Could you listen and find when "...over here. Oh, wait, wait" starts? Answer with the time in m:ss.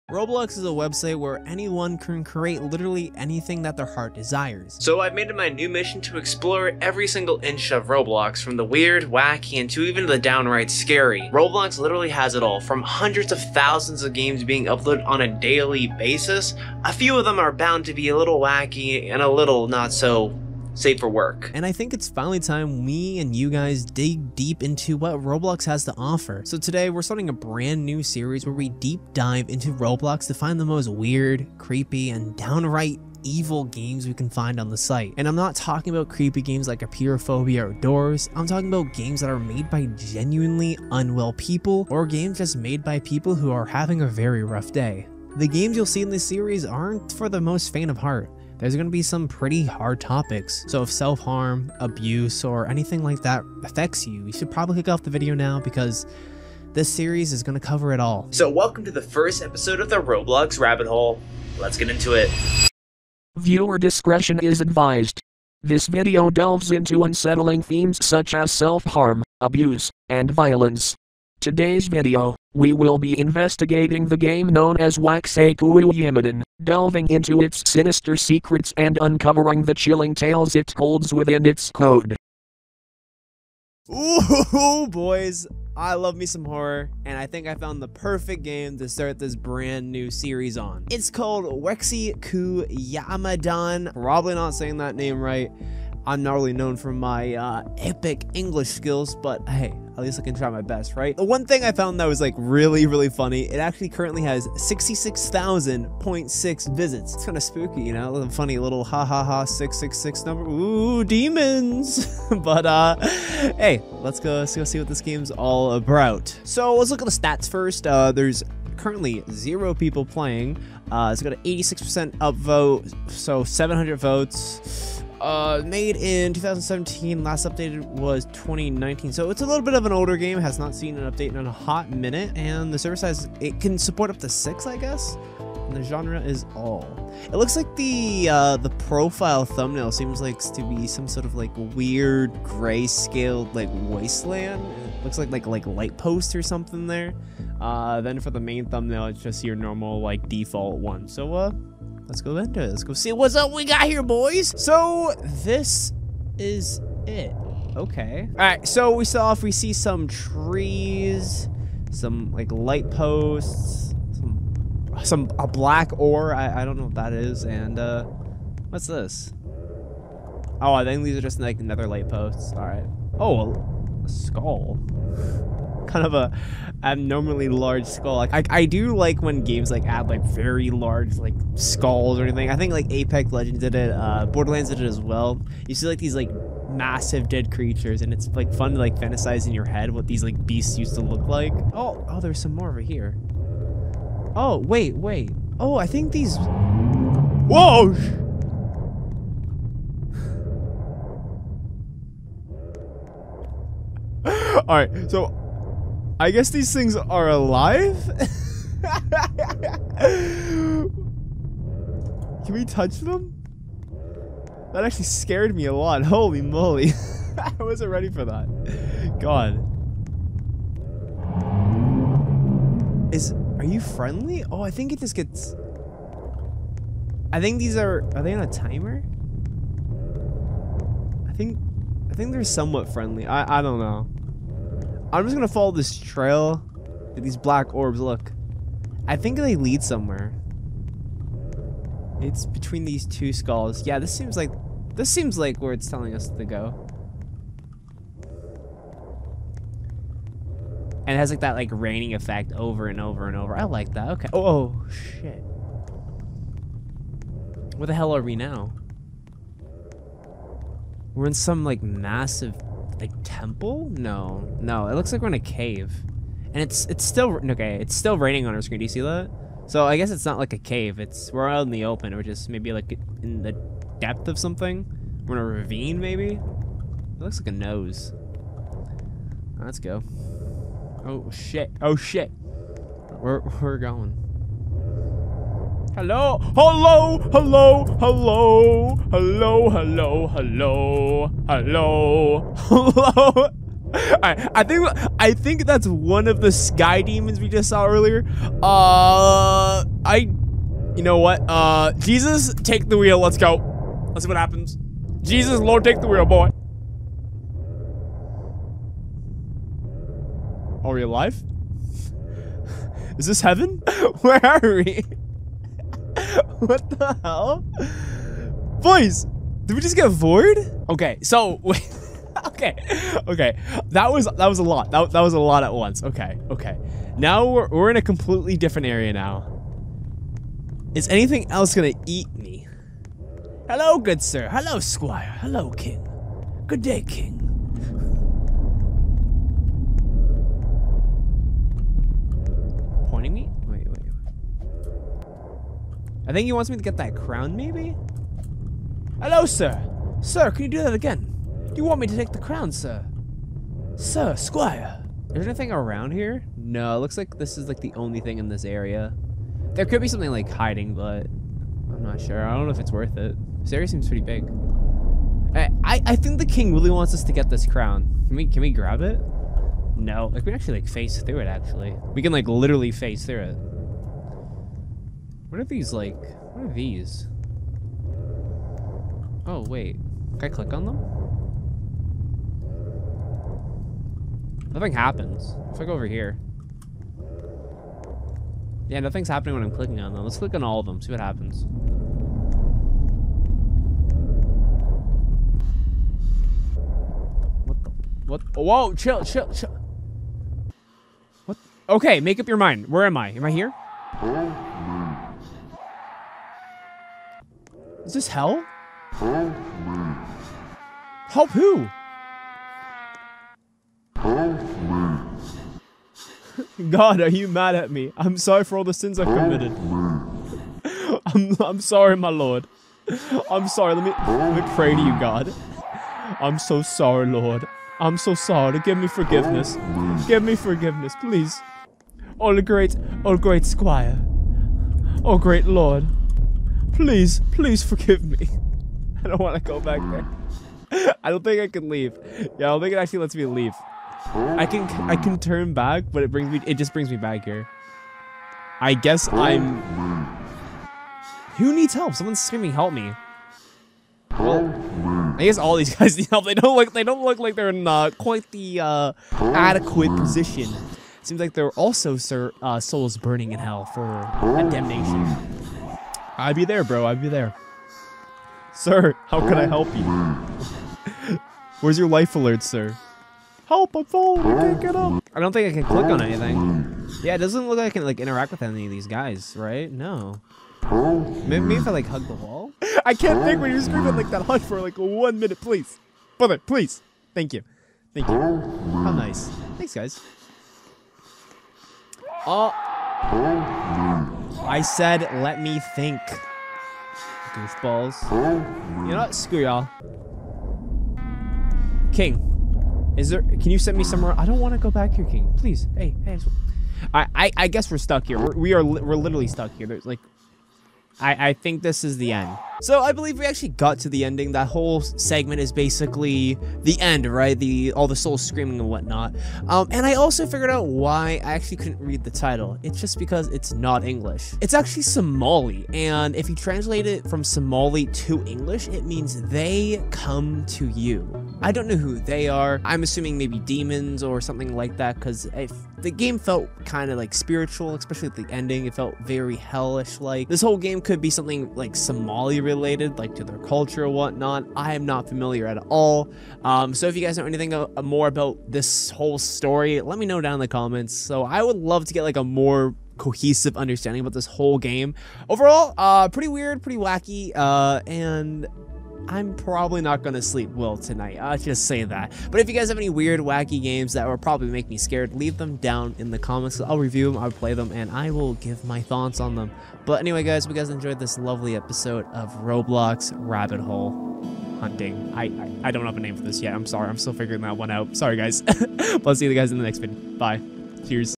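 3:12.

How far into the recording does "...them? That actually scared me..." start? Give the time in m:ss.
3:32.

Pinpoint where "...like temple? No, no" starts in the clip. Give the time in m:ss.
4:23.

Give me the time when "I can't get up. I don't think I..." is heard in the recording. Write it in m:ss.
7:54.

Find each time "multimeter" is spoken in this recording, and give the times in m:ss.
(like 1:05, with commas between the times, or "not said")
not said.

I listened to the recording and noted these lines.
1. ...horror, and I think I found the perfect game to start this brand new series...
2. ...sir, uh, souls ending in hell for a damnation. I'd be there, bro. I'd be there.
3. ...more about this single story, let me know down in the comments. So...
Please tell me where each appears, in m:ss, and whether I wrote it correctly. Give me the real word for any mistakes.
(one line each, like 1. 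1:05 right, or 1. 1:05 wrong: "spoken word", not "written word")
1. 1:26 right
2. 7:42 wrong: "burning", not "ending"
3. 9:08 wrong: "whole", not "single".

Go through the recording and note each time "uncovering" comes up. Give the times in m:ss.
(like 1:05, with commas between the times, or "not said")
1:19.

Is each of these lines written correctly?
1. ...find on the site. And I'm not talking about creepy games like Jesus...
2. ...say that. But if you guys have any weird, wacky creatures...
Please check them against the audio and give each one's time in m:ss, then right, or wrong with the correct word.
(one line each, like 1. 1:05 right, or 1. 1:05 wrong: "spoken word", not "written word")
1. 0:34 wrong: "Apeirophobia", not "Jesus"
2. 9:21 wrong: "games", not "creatures".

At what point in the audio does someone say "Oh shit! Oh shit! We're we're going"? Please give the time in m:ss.
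4:41.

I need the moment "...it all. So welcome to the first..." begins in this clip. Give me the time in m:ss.
0:57.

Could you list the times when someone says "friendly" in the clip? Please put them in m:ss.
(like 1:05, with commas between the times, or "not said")
3:43, 3:52.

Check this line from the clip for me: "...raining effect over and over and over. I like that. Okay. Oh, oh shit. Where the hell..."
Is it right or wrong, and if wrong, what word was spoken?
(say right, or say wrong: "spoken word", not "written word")
right.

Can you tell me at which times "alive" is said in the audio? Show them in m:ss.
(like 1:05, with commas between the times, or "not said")
3:27, 5:11.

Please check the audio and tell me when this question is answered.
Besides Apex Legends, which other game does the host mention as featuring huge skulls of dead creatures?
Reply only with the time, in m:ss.
3:04.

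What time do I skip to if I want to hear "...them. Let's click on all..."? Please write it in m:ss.
6:30.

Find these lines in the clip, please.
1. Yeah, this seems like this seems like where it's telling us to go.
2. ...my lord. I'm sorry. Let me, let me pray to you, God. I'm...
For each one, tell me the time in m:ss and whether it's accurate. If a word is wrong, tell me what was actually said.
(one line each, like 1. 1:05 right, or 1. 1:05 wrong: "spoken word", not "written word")
1. 4:03 right
2. 7:02 right.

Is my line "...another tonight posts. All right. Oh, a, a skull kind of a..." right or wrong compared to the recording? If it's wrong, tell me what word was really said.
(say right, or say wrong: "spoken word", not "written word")
wrong: "light", not "tonight".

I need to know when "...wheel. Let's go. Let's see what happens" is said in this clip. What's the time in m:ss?
5:02.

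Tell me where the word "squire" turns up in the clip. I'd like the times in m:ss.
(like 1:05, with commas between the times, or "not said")
5:34, 5:54, 7:13.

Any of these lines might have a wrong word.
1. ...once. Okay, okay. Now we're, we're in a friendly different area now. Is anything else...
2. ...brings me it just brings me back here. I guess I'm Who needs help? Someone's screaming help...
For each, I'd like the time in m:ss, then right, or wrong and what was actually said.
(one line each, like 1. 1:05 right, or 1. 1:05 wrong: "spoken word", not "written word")
1. 5:25 wrong: "completely", not "friendly"
2. 7:26 right.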